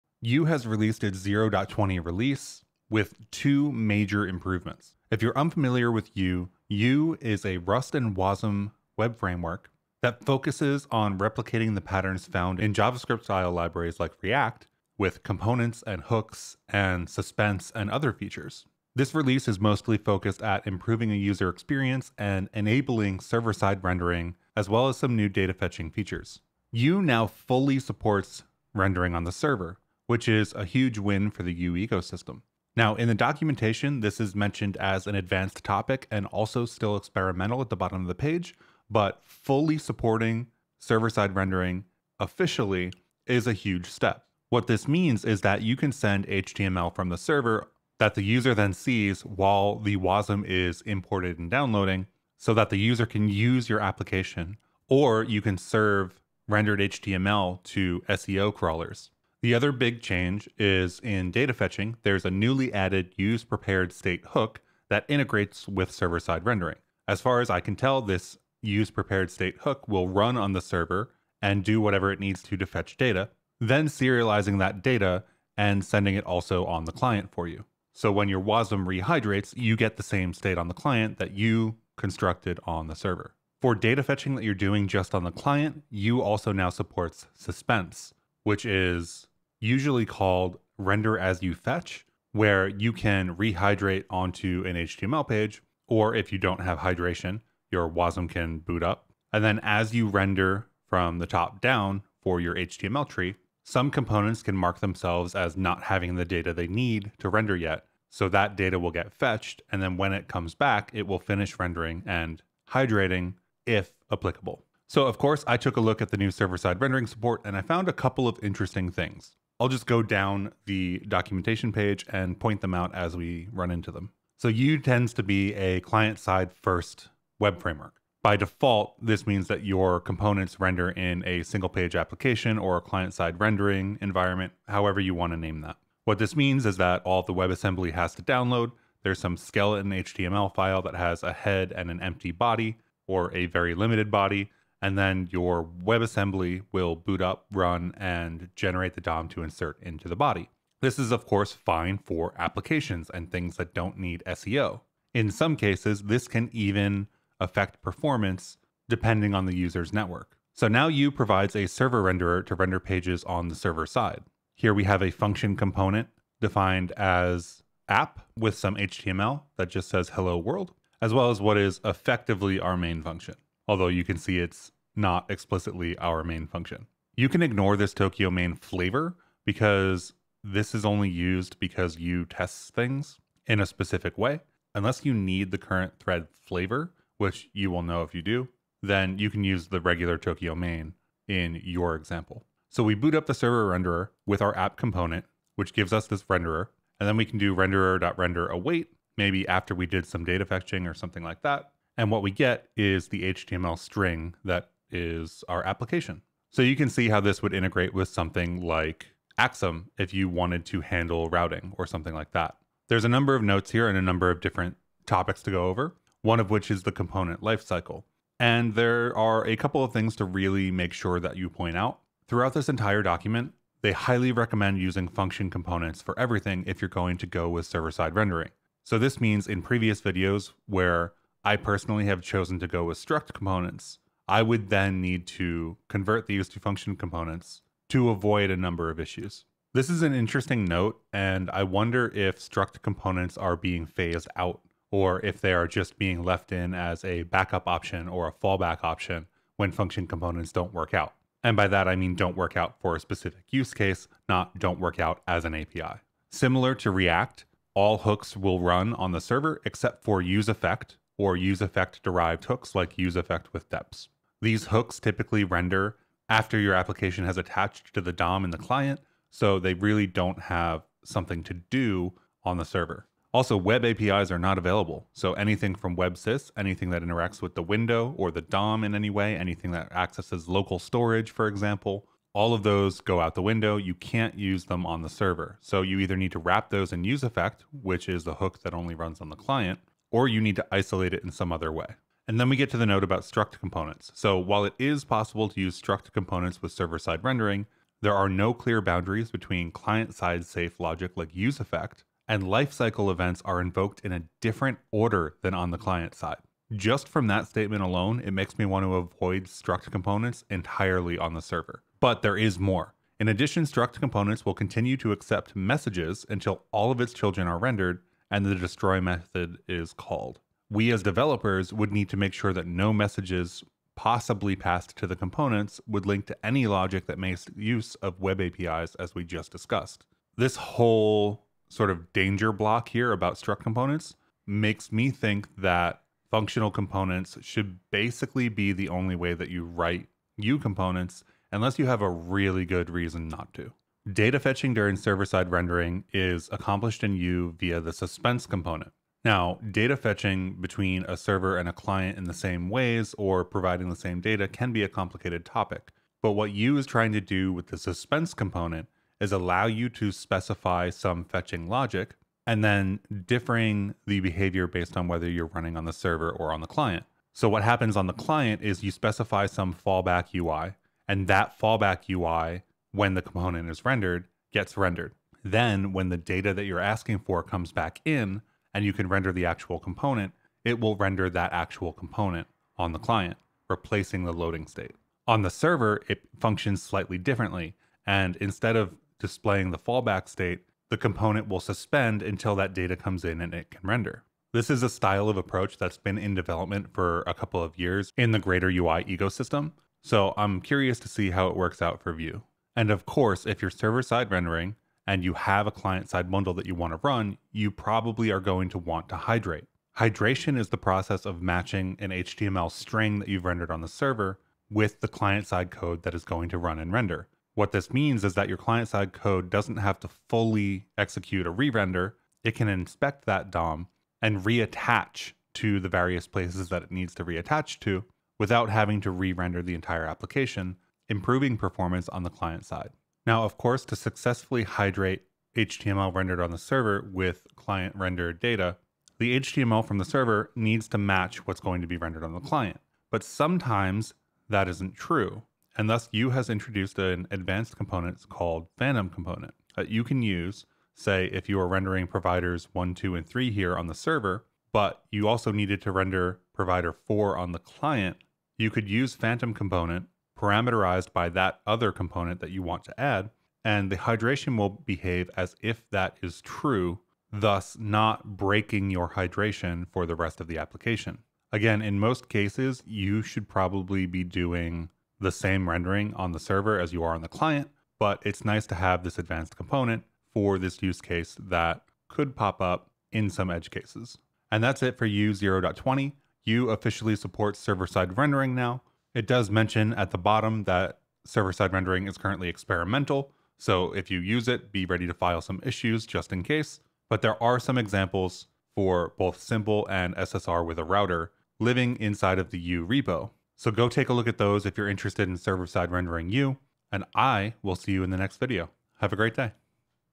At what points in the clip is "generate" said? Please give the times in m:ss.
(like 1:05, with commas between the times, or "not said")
2:28.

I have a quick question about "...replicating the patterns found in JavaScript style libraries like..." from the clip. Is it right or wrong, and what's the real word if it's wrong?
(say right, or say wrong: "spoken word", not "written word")
right.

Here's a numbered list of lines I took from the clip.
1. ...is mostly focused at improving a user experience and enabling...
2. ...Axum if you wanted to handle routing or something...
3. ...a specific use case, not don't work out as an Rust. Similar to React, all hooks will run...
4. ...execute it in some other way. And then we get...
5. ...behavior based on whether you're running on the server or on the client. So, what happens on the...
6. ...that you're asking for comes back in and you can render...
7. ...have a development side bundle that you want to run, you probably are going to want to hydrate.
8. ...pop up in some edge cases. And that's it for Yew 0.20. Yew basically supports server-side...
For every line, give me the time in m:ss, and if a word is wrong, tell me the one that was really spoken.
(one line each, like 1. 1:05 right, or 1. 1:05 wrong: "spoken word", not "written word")
1. 0:19 right
2. 3:29 right
3. 4:12 wrong: "API", not "Rust"
4. 4:50 wrong: "isolate", not "execute"
5. 6:04 right
6. 6:16 right
7. 6:45 wrong: "client", not "development"
8. 8:02 wrong: "officially", not "basically".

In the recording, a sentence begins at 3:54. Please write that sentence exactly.
I would then need to convert these to function components to avoid a number of issues.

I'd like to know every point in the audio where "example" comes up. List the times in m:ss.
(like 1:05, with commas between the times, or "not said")
3:11, 4:41, 8:17.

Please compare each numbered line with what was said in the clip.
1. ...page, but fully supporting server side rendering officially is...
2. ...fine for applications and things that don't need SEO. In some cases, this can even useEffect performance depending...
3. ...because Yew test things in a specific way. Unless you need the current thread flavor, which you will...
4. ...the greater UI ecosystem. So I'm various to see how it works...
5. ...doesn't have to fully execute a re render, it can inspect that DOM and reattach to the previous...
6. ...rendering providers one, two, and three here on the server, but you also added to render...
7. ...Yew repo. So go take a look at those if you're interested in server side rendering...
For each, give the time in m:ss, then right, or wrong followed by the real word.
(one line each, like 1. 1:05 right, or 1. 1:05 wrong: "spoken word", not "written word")
1. 0:38 right
2. 2:31 wrong: "affect", not "useEffect"
3. 3:01 right
4. 6:38 wrong: "curious", not "various"
5. 6:59 wrong: "various", not "previous"
6. 7:31 wrong: "needed", not "added"
7. 8:22 right.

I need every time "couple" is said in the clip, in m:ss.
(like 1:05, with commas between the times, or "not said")
1:57, 3:39, 6:37.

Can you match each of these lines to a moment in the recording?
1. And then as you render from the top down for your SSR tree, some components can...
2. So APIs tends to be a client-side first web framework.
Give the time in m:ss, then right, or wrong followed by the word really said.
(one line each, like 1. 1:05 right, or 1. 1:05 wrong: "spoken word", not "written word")
1. 1:39 wrong: "HTML", not "SSR"
2. 2:04 wrong: "Yew", not "APIs".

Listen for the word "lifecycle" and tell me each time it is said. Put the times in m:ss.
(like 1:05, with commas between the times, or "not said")
3:37, 5:02.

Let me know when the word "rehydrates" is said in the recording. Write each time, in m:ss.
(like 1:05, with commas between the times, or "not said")
1:18, 1:33.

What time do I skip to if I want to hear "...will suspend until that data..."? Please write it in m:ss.
6:31.